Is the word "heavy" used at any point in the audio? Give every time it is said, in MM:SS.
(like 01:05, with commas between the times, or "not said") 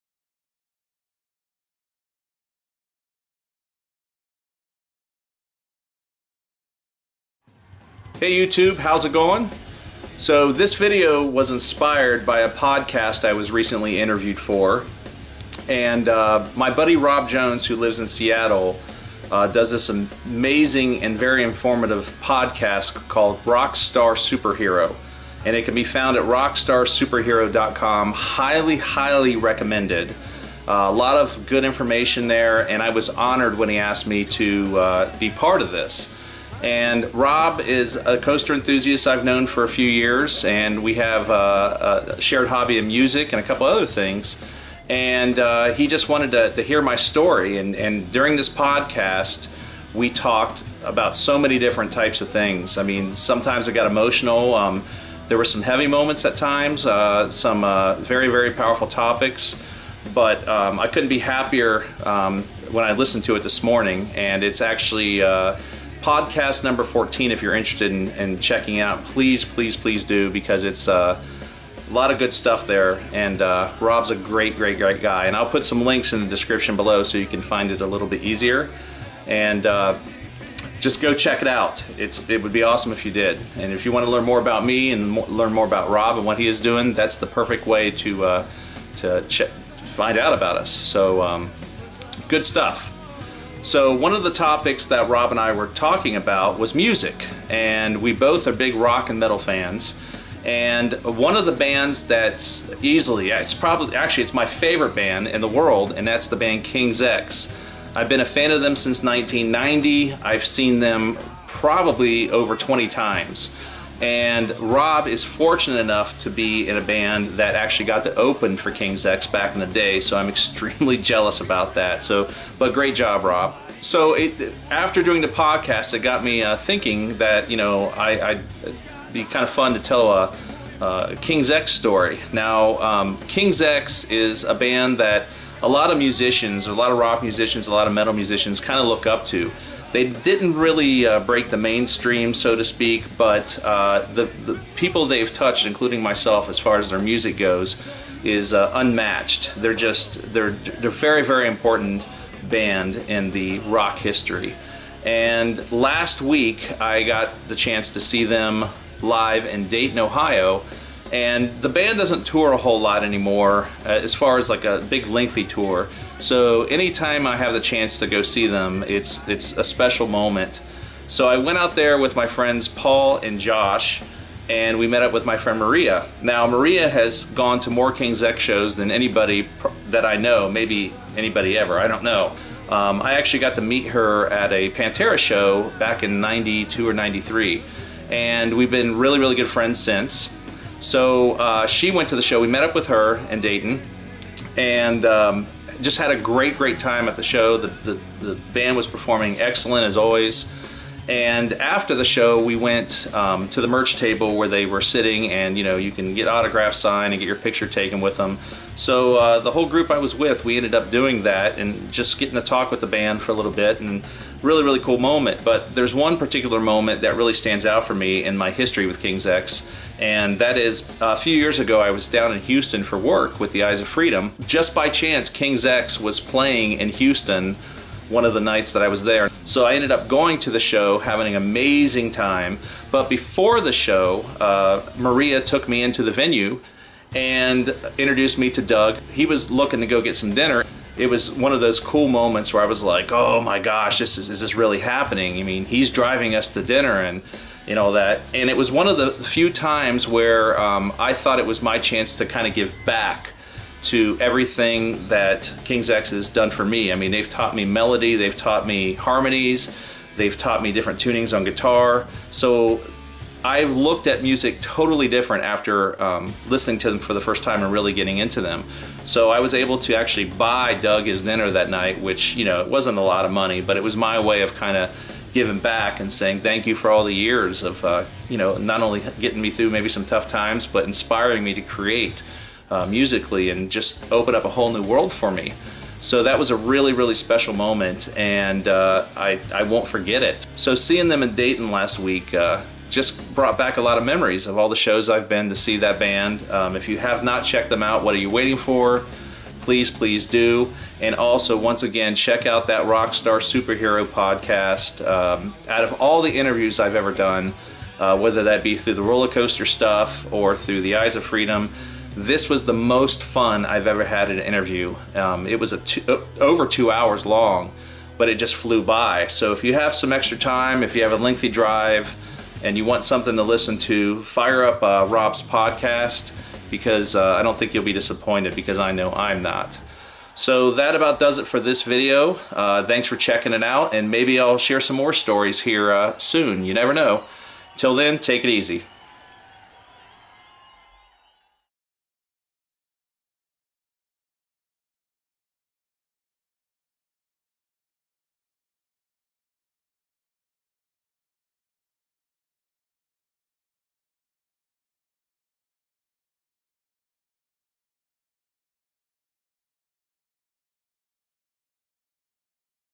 00:55.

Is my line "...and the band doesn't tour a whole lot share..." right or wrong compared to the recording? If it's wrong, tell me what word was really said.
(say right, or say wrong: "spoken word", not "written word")
wrong: "anymore", not "share".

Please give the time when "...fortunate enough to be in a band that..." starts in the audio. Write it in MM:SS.
01:55.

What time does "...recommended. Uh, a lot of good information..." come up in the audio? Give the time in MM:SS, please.
00:29.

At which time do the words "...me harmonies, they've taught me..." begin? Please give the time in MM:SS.
04:18.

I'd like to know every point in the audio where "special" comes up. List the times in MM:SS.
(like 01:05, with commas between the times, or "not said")
02:49, 04:47.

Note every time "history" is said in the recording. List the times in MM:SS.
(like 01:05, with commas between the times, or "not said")
02:33, 03:38.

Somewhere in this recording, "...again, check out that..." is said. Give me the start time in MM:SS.
05:01.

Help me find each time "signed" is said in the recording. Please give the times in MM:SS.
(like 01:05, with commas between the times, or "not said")
03:26.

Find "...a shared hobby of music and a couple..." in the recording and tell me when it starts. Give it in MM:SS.
00:42.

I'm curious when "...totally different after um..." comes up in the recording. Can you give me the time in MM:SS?
04:24.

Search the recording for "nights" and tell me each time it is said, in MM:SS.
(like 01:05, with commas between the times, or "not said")
03:48, 04:31.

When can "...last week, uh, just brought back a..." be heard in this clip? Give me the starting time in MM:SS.
04:51.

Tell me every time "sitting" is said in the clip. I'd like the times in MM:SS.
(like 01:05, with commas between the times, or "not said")
03:24.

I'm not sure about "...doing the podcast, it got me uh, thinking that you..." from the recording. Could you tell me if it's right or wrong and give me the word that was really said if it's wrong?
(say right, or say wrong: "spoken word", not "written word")
right.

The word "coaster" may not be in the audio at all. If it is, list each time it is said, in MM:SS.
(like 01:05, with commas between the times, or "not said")
00:38, 05:09.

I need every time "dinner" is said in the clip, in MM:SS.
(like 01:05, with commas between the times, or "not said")
04:00, 04:06, 04:31.